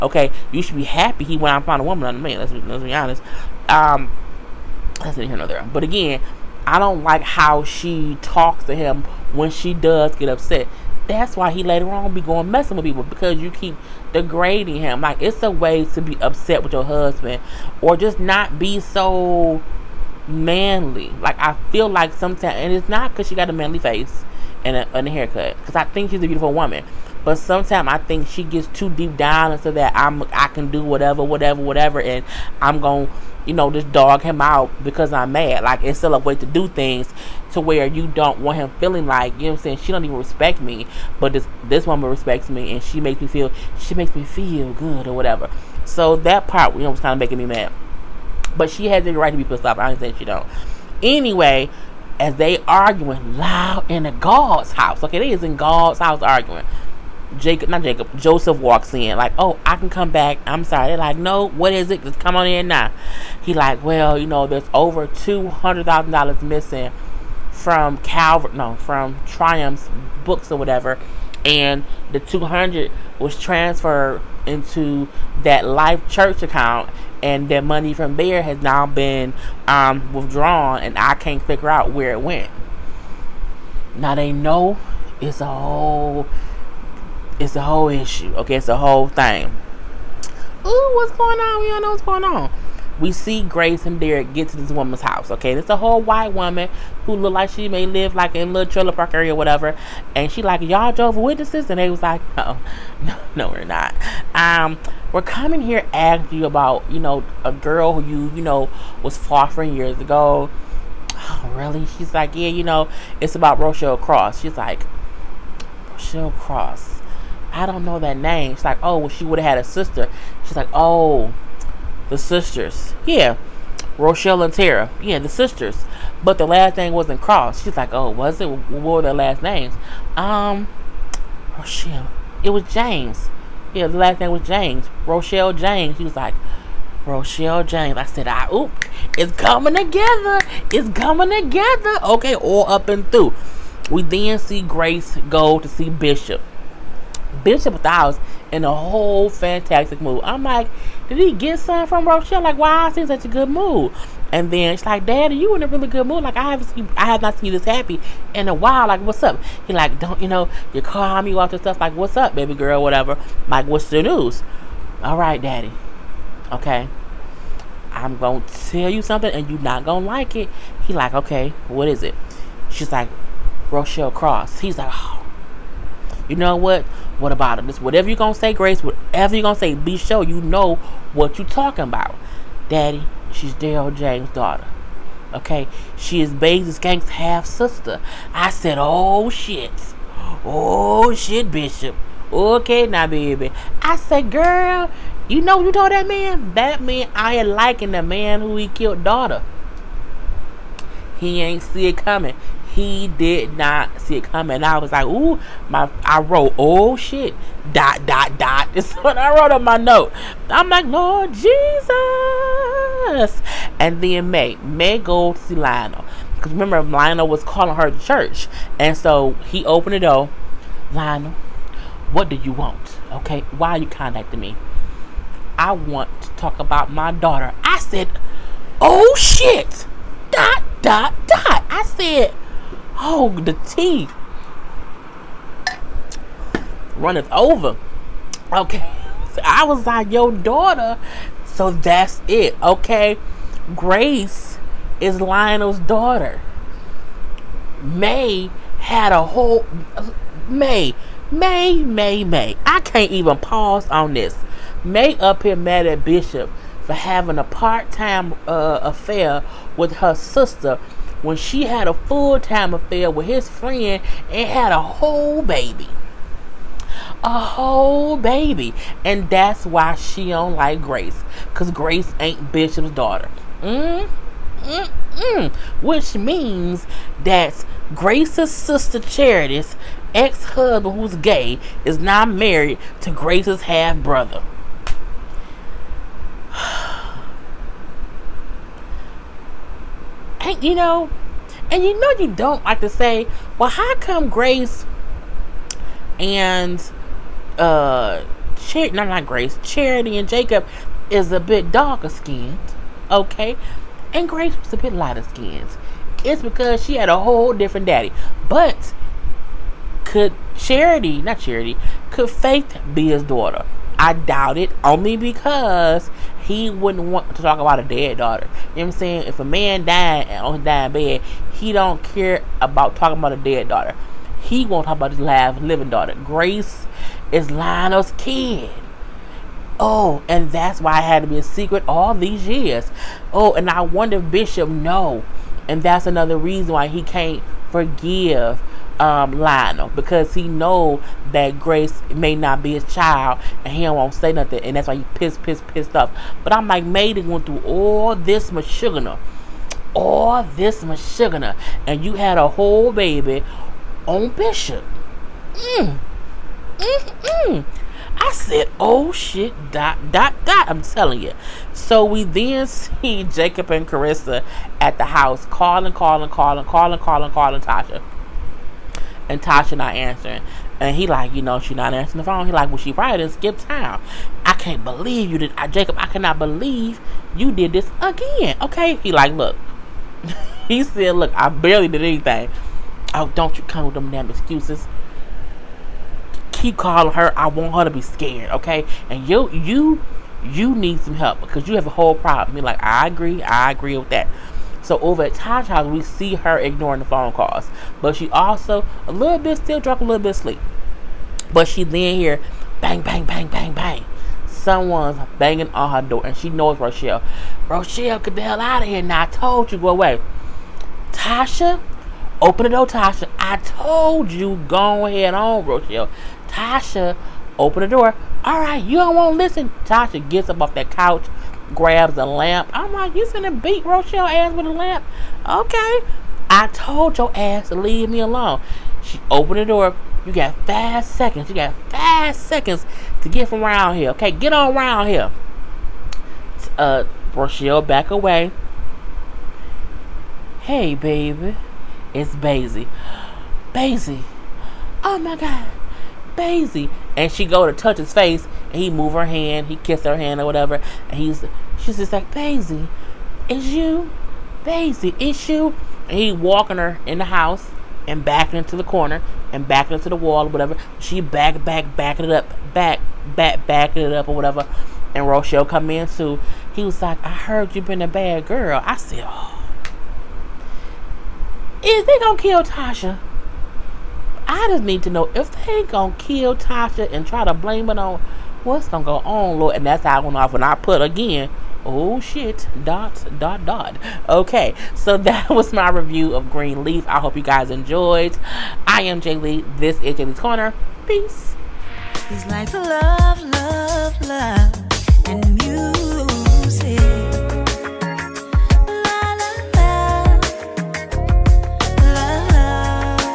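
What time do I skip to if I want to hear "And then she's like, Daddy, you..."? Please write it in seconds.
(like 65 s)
154 s.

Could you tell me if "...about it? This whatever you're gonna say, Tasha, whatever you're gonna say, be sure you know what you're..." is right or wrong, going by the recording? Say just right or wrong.
wrong.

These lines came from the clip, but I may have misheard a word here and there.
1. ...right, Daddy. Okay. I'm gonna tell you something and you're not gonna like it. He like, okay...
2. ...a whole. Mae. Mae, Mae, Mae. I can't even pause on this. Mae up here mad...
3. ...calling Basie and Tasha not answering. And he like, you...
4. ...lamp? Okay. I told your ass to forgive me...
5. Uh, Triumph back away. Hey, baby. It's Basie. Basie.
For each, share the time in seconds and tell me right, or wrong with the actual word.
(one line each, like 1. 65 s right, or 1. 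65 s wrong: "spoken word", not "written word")
1. 165 s right
2. 249 s right
3. 367 s wrong: "Tasha", not "Basie"
4. 424 s wrong: "leave", not "forgive"
5. 436 s wrong: "Rochelle", not "Triumph".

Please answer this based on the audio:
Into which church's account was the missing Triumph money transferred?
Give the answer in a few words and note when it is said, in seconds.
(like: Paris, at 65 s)
Life Church, at 75 s.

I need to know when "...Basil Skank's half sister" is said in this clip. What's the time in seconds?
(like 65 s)
186 s.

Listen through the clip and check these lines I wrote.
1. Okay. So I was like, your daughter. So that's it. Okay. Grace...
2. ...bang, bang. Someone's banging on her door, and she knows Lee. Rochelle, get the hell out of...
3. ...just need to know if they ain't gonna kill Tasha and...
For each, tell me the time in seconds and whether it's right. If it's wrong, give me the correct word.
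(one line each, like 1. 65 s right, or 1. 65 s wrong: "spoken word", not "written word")
1. 238 s right
2. 403 s wrong: "Rochelle", not "Lee"
3. 474 s right.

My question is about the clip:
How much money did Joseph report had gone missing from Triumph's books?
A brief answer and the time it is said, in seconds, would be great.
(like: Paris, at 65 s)
$200,000, at 65 s.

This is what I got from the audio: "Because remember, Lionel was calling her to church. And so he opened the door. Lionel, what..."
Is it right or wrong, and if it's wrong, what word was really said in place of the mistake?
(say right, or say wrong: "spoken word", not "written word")
right.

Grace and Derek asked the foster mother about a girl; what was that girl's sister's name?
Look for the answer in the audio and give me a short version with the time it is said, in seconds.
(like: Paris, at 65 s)
Tara, at 124 s.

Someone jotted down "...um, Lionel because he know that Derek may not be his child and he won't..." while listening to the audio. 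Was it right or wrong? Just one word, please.
wrong.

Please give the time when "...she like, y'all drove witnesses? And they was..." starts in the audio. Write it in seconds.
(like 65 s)
100 s.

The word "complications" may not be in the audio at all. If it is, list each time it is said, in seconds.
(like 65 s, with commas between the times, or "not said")
not said.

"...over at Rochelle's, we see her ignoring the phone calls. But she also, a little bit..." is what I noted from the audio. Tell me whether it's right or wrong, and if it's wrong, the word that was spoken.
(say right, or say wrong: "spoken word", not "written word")
wrong: "Tasha", not "Rochelle".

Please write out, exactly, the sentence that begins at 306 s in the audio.
It's because she had a whole different daddy, but could Charity, not Charity, could Faith be his daughter?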